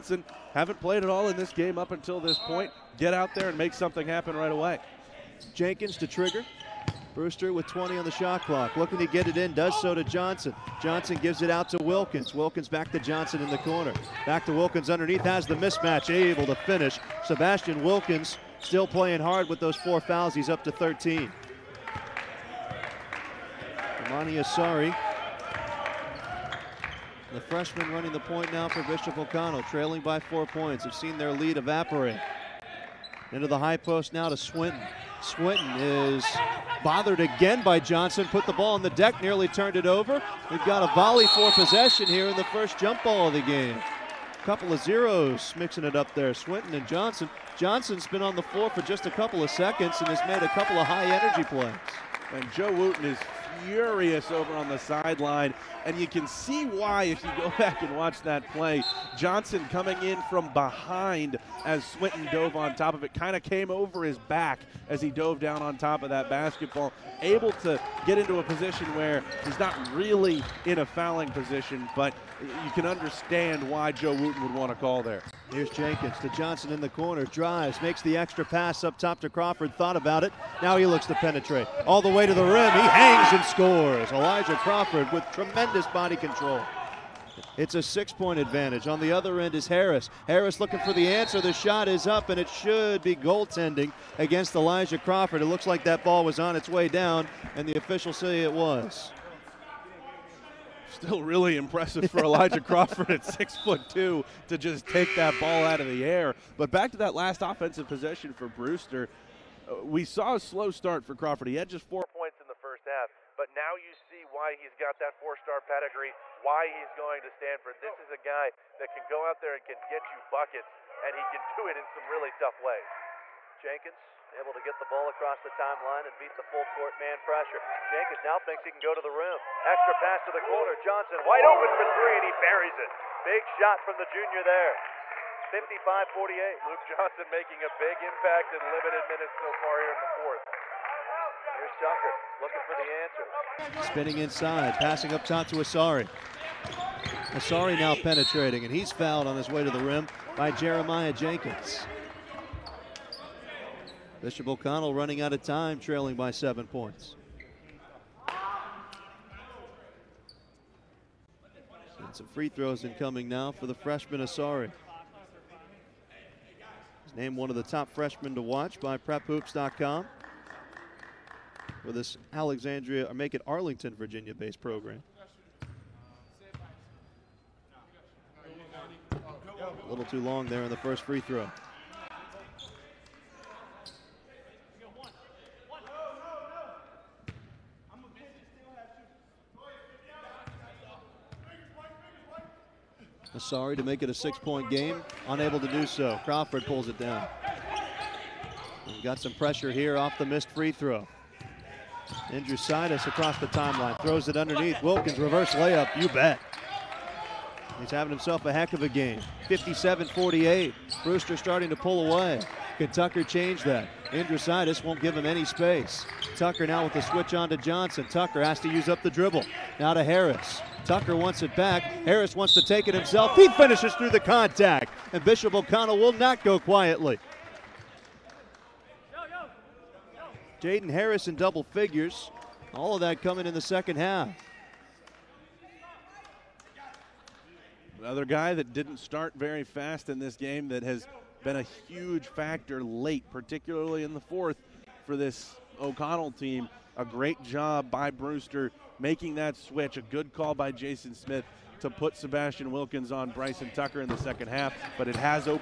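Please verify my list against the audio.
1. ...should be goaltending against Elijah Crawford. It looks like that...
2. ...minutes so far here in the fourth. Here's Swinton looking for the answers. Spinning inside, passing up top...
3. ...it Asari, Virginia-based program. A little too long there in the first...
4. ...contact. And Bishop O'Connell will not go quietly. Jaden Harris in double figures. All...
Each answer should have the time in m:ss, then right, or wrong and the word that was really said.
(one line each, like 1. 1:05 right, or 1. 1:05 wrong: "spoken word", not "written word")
1. 1:32 right
2. 2:19 wrong: "Tucker", not "Swinton"
3. 2:53 wrong: "Arlington", not "Asari"
4. 3:44 right.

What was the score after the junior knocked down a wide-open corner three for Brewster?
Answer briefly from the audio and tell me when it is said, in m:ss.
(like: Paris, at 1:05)
55-48, at 2:15.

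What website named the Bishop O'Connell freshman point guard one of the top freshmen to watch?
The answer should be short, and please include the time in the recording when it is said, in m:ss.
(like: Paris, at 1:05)
PrepHoops.com, at 2:48.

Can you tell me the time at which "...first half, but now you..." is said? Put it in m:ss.
1:52.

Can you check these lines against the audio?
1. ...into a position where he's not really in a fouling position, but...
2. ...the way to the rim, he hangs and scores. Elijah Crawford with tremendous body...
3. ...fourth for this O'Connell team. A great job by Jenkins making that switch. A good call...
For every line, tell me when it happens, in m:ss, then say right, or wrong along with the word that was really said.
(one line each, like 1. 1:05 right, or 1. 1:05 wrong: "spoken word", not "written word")
1. 1:08 right
2. 1:22 right
3. 4:04 wrong: "Brewster", not "Jenkins".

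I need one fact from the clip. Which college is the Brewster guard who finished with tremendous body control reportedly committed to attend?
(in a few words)
Stanford.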